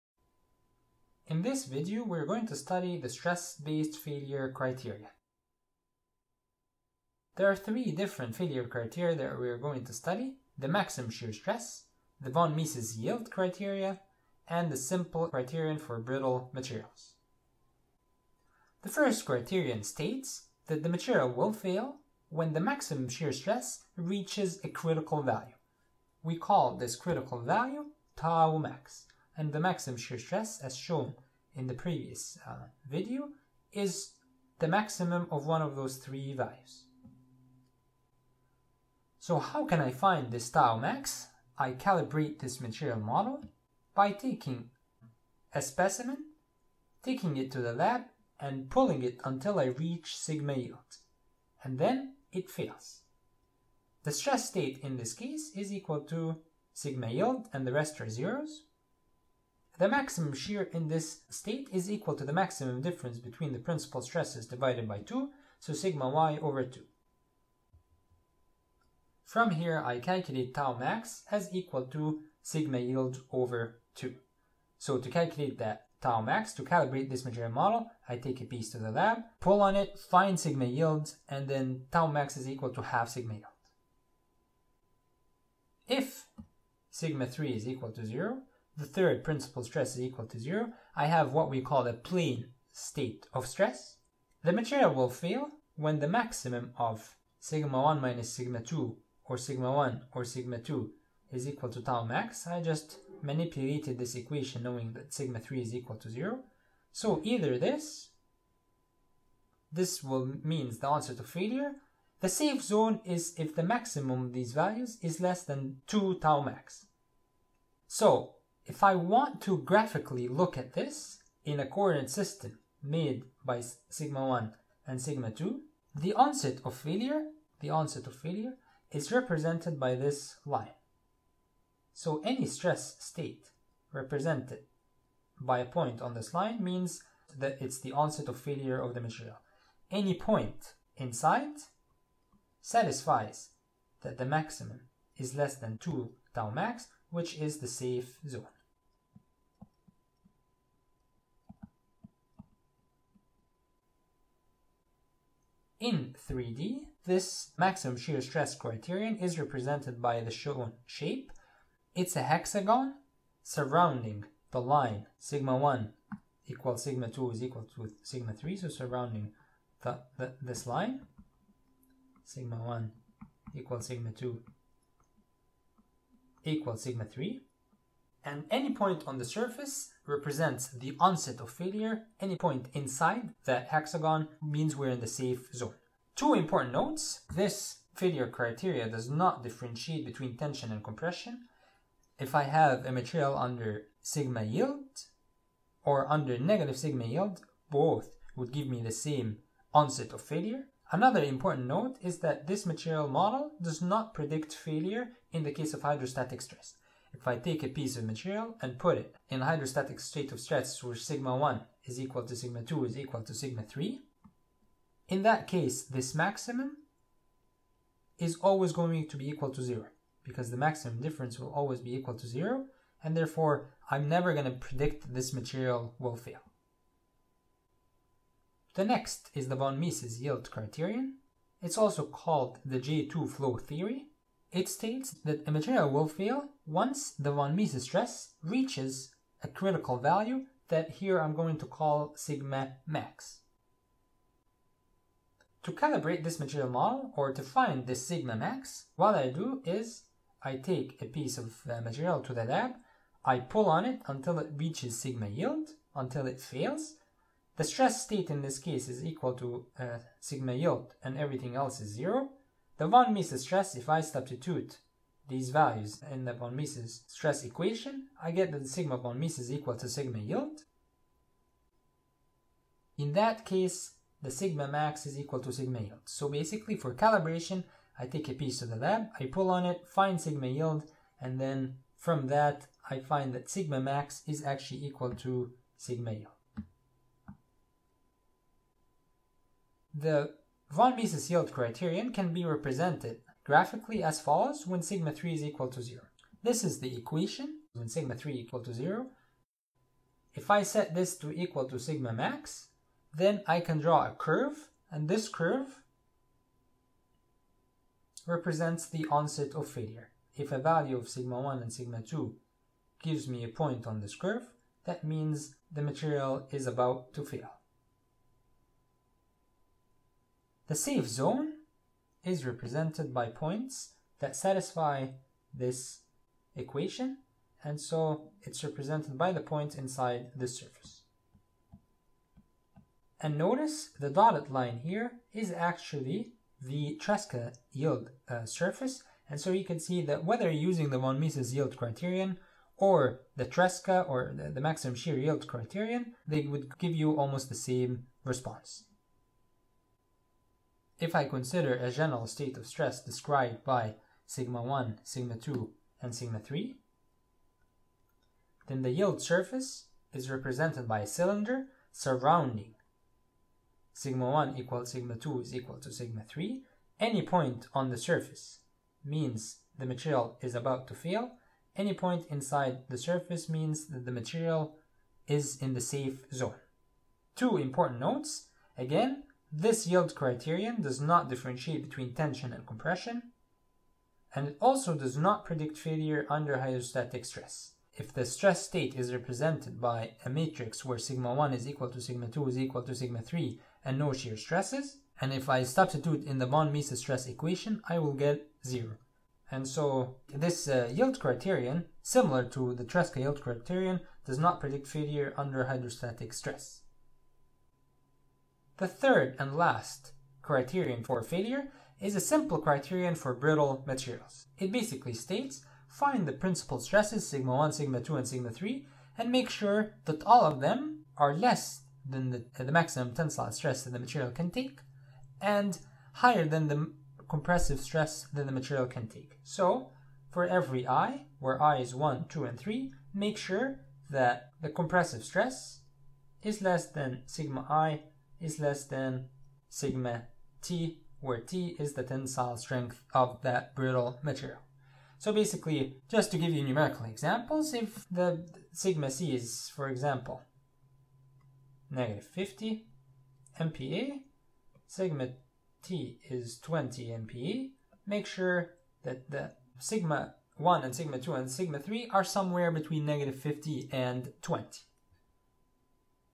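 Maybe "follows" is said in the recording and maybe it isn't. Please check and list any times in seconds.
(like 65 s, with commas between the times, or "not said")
294 s.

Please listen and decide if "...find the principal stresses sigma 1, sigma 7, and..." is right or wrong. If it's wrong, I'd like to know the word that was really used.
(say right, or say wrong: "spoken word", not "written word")
wrong: "2", not "7".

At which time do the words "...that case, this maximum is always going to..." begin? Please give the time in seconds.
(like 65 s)
215 s.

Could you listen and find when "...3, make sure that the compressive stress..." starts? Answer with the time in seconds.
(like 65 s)
432 s.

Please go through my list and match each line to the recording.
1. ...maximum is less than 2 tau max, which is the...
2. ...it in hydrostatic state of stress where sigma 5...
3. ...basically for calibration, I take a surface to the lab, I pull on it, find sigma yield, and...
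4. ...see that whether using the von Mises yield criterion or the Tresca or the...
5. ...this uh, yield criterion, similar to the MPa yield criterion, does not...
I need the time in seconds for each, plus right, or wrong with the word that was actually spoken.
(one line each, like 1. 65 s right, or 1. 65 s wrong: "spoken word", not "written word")
1. 144 s right
2. 208 s wrong: "1", not "5"
3. 276 s wrong: "piece", not "surface"
4. 339 s right
5. 400 s wrong: "Tresca", not "MPa".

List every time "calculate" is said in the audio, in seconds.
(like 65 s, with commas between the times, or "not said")
69 s, 75 s.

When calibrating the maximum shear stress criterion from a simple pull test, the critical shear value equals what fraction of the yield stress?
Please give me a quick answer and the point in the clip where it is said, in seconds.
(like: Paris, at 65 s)
half sigma yield, at 82 s.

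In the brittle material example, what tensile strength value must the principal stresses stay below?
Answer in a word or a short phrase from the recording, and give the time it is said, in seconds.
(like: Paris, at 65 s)
20 MPa, at 456 s.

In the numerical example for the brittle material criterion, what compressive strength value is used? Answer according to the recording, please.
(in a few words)
-50 MPa.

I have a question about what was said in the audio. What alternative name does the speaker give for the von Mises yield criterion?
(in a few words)
J2 flow theory.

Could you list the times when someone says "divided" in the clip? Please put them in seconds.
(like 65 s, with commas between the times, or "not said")
64 s.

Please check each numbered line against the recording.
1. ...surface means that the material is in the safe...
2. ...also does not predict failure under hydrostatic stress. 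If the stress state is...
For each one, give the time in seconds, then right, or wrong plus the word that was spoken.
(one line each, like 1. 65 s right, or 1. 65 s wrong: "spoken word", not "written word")
1. 372 s right
2. 384 s right.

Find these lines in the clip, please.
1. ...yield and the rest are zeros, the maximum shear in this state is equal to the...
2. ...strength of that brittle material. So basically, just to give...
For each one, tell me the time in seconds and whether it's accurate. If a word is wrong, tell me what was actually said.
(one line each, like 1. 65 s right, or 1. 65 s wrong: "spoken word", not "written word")
1. 57 s right
2. 442 s right.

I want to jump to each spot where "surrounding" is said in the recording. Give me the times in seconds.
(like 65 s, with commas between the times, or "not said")
163 s, 168 s, 361 s.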